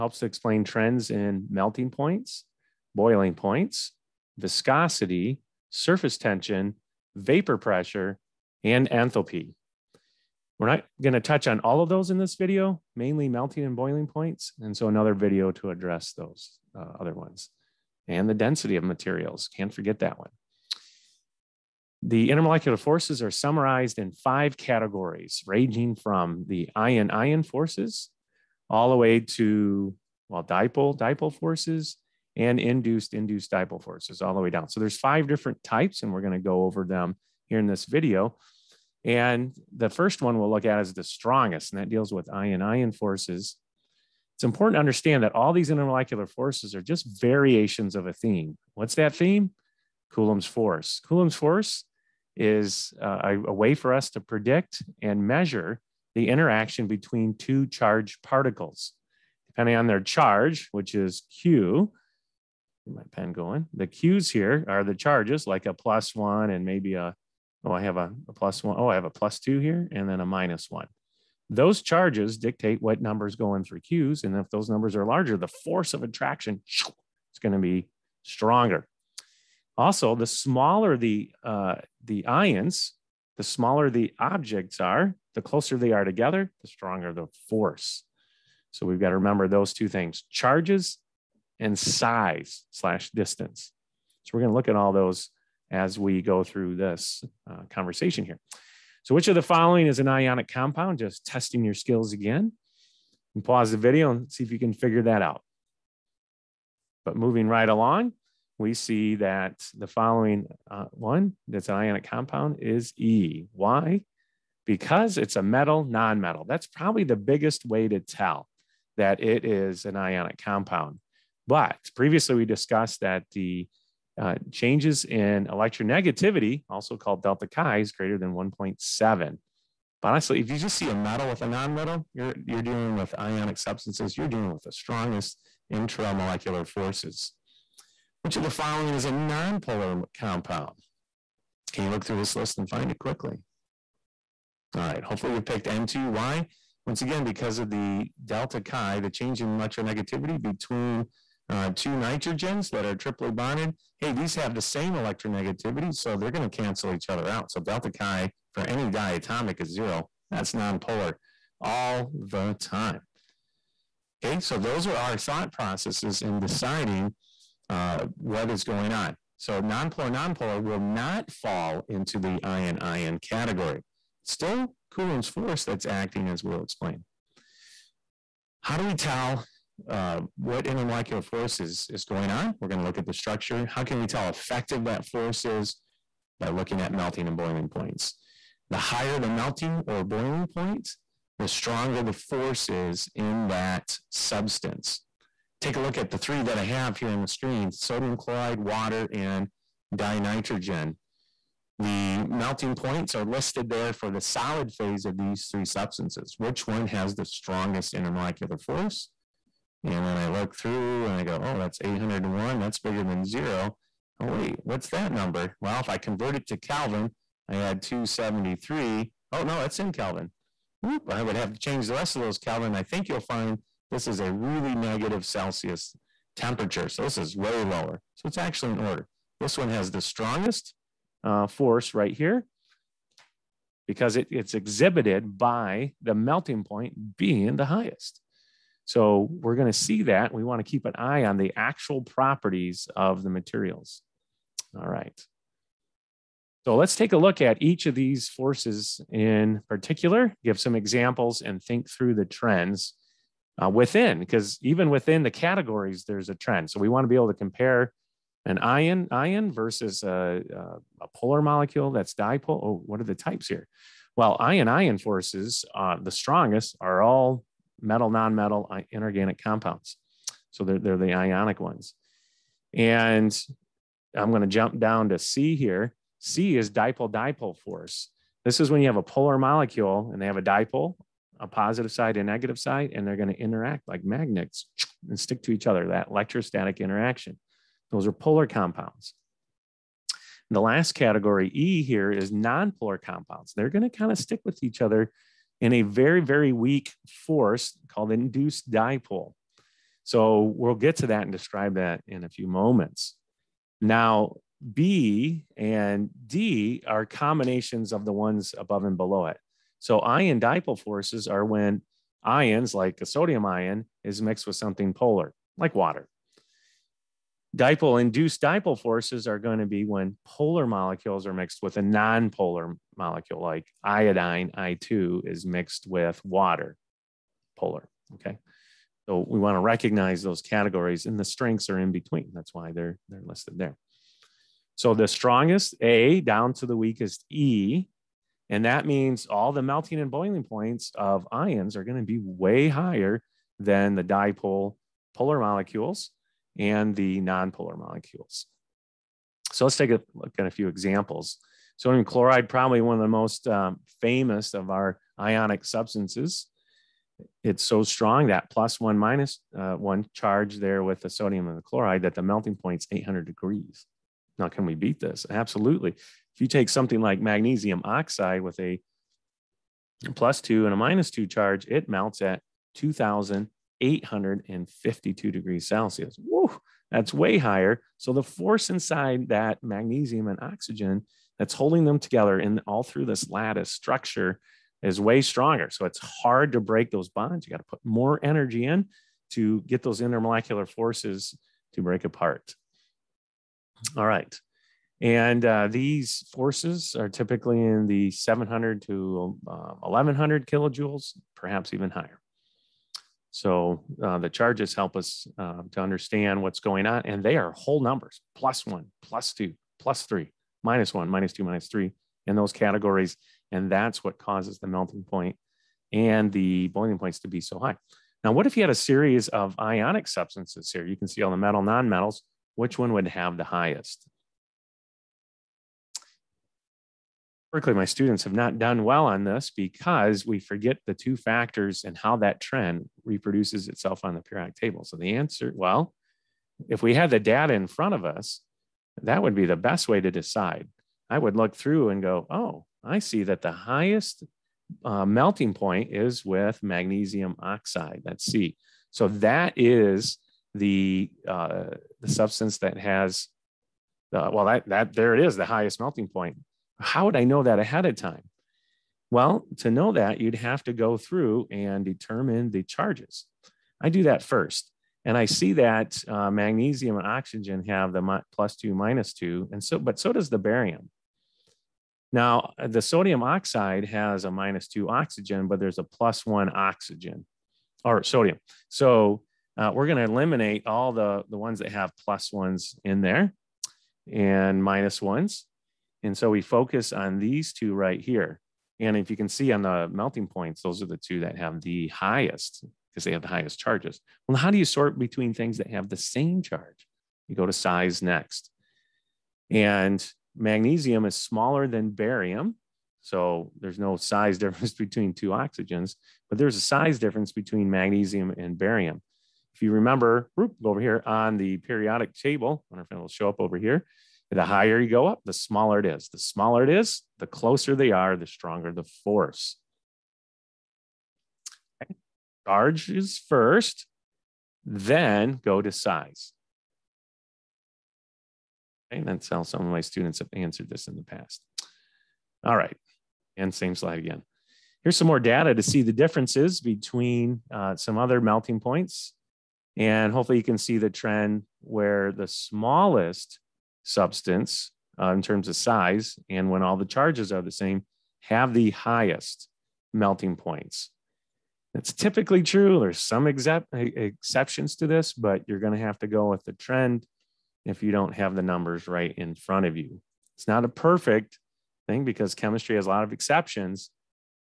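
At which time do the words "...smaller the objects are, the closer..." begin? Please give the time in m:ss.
1:23.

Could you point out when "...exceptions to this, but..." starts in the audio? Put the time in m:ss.
9:13.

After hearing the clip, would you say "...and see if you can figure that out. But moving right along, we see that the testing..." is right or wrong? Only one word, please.
wrong.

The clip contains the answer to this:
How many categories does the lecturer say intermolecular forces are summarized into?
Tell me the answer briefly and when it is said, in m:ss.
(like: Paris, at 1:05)
5, at 0:24.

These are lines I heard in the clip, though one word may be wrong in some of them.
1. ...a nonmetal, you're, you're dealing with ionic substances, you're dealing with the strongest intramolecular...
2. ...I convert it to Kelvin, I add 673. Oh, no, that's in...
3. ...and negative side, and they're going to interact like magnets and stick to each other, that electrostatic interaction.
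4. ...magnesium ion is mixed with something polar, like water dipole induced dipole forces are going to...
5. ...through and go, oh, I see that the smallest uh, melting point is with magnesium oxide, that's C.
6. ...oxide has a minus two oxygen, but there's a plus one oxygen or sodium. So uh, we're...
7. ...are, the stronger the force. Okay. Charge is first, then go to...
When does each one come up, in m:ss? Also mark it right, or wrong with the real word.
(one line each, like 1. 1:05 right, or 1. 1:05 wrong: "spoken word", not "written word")
1. 2:11 right
2. 3:35 wrong: "273", not "673"
3. 4:42 right
4. 5:13 wrong: "sodium", not "magnesium"
5. 7:21 wrong: "highest", not "smallest"
6. 7:53 right
7. 8:37 right.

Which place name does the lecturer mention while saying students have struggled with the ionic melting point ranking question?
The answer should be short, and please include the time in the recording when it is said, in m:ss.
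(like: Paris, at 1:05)
Berkeley, at 7:07.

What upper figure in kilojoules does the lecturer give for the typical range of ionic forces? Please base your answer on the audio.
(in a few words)
1100.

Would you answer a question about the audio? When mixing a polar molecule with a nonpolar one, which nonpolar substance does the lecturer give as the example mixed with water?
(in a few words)
iodine.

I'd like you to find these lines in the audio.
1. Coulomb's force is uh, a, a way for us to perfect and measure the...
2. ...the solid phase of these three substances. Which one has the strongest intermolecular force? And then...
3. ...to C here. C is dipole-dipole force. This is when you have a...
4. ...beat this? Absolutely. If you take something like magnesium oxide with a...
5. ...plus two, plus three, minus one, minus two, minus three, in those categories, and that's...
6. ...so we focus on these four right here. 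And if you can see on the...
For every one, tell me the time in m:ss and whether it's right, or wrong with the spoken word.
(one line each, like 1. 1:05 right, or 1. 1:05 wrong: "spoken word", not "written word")
1. 0:51 wrong: "predict", not "perfect"
2. 3:24 right
3. 4:35 right
4. 6:04 right
5. 6:49 right
6. 8:06 wrong: "two", not "four".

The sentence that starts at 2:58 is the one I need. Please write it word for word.
How do we tell uh, what intermolecular force is, is going on.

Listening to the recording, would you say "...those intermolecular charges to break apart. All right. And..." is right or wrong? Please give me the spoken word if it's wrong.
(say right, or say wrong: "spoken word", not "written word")
wrong: "forces", not "charges".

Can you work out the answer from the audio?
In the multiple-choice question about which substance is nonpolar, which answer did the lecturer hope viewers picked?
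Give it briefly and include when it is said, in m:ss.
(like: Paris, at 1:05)
N2, at 2:25.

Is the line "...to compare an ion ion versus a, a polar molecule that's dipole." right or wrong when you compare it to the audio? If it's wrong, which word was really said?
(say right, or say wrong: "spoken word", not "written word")
right.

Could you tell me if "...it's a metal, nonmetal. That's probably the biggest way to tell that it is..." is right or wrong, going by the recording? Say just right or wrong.
right.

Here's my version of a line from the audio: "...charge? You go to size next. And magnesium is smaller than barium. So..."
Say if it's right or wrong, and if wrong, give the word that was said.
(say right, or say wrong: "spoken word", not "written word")
right.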